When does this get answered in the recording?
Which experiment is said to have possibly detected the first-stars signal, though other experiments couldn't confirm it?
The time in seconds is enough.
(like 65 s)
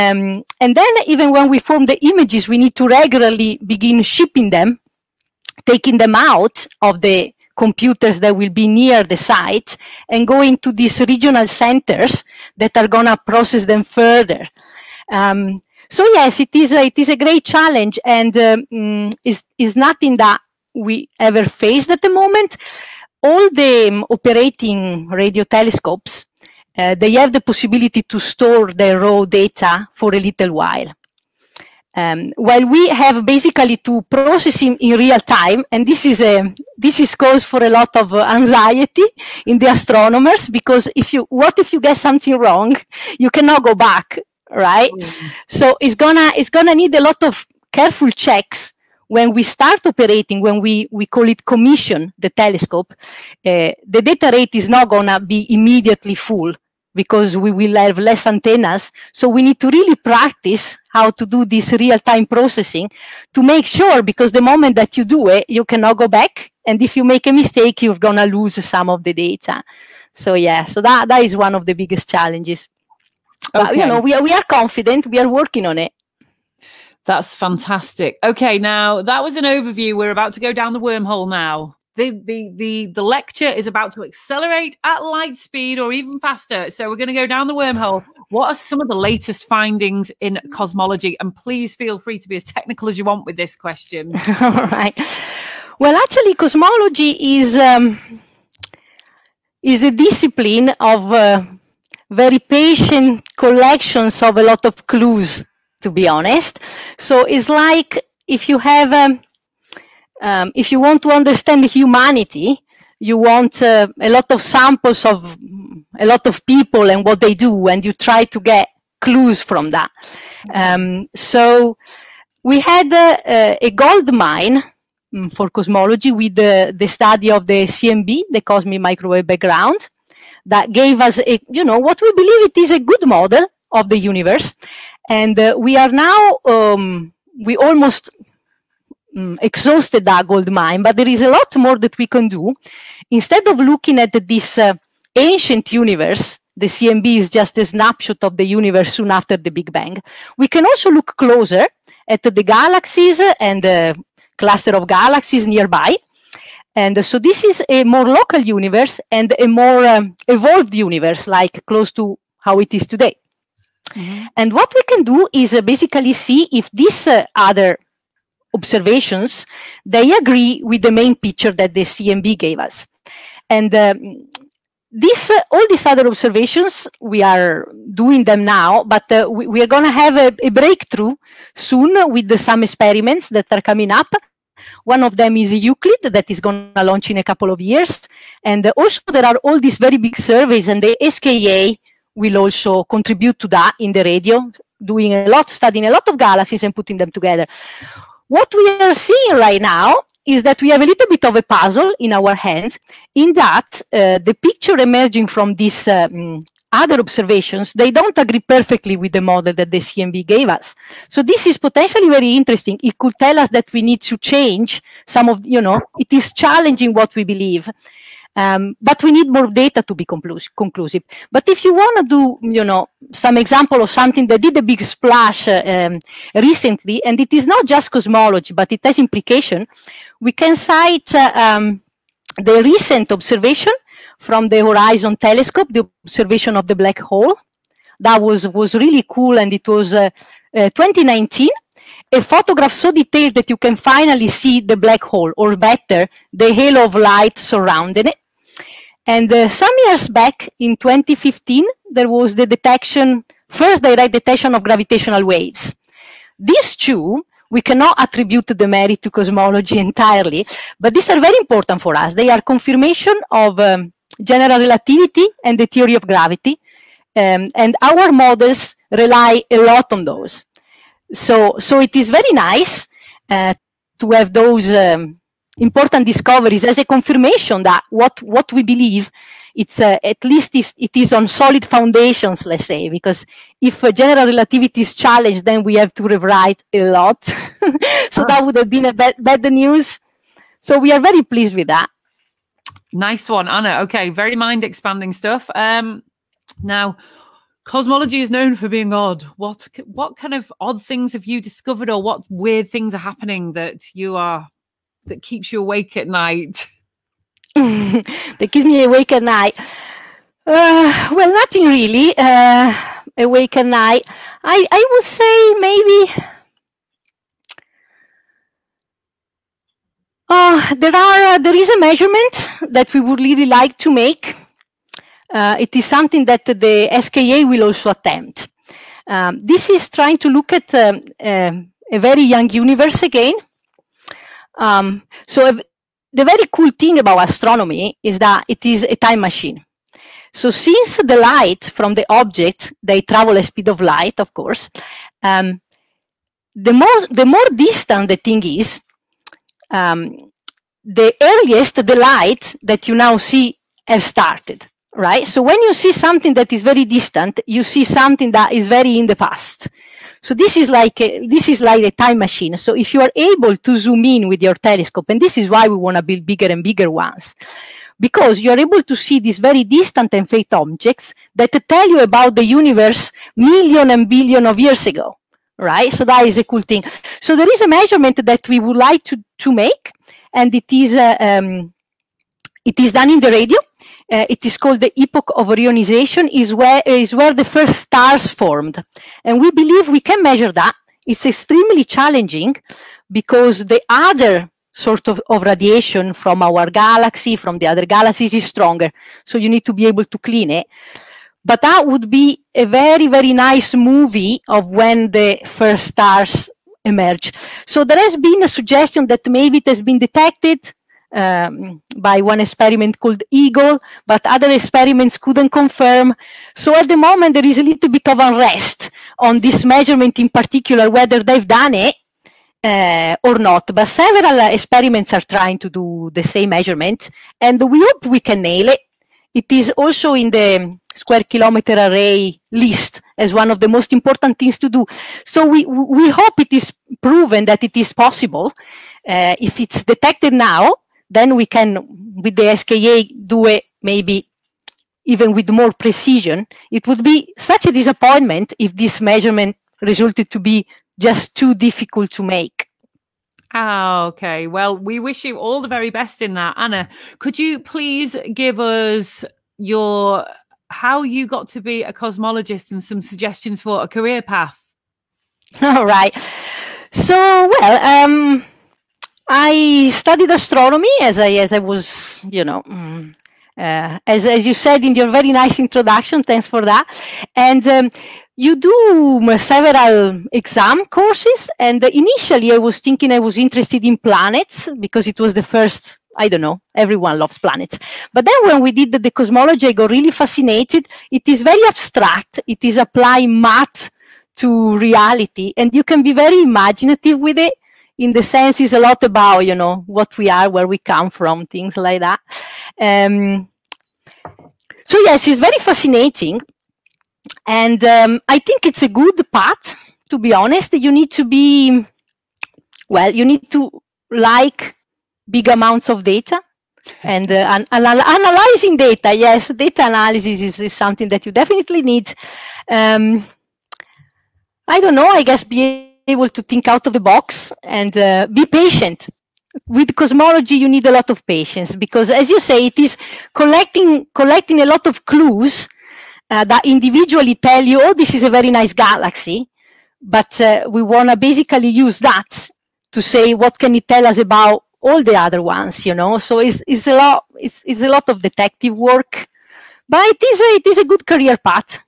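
413 s.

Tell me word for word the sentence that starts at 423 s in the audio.
But several uh, experiments are trying to do the same measurement, and we hope we can nail it.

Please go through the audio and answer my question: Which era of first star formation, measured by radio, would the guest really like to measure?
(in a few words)
Epoch of reionization.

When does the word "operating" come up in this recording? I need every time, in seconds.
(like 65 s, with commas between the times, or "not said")
24 s, 49 s.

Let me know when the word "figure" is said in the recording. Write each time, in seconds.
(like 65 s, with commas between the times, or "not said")
not said.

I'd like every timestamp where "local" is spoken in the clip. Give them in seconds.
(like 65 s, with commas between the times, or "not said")
158 s.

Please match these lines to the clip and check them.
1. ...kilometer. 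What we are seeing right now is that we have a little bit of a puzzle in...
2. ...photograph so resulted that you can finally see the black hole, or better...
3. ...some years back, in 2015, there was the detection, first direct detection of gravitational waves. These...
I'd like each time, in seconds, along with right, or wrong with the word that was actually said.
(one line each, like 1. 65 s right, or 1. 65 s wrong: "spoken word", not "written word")
1. 197 s wrong: "together", not "kilometer"
2. 242 s wrong: "detailed", not "resulted"
3. 249 s right.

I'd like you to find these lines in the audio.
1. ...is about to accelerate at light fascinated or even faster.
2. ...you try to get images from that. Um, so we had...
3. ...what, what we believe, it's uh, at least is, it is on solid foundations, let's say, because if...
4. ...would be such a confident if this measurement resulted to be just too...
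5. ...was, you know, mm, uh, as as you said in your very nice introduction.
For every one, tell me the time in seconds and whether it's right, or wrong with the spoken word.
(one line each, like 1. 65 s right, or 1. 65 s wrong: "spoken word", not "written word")
1. 83 s wrong: "speed", not "fascinated"
2. 117 s wrong: "clues", not "images"
3. 277 s right
4. 446 s wrong: "disappointment", not "confident"
5. 471 s right.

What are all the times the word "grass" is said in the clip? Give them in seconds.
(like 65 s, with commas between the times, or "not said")
not said.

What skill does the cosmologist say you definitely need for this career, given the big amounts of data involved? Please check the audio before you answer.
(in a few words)
Data analysis.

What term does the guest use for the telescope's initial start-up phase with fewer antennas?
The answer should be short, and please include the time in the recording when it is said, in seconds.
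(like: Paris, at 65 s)
Commission, at 51 s.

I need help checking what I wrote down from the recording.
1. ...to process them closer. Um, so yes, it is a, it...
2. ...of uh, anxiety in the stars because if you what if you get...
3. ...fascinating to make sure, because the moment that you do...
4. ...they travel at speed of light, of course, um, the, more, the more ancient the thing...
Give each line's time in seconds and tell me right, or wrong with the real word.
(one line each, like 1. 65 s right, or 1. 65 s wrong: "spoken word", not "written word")
1. 13 s wrong: "further", not "closer"
2. 37 s wrong: "astronomers", not "stars"
3. 62 s wrong: "processing", not "fascinating"
4. 342 s wrong: "distant", not "ancient".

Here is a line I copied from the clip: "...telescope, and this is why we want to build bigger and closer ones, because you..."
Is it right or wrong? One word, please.
wrong.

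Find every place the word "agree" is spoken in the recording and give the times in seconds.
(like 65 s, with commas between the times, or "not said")
170 s, 208 s.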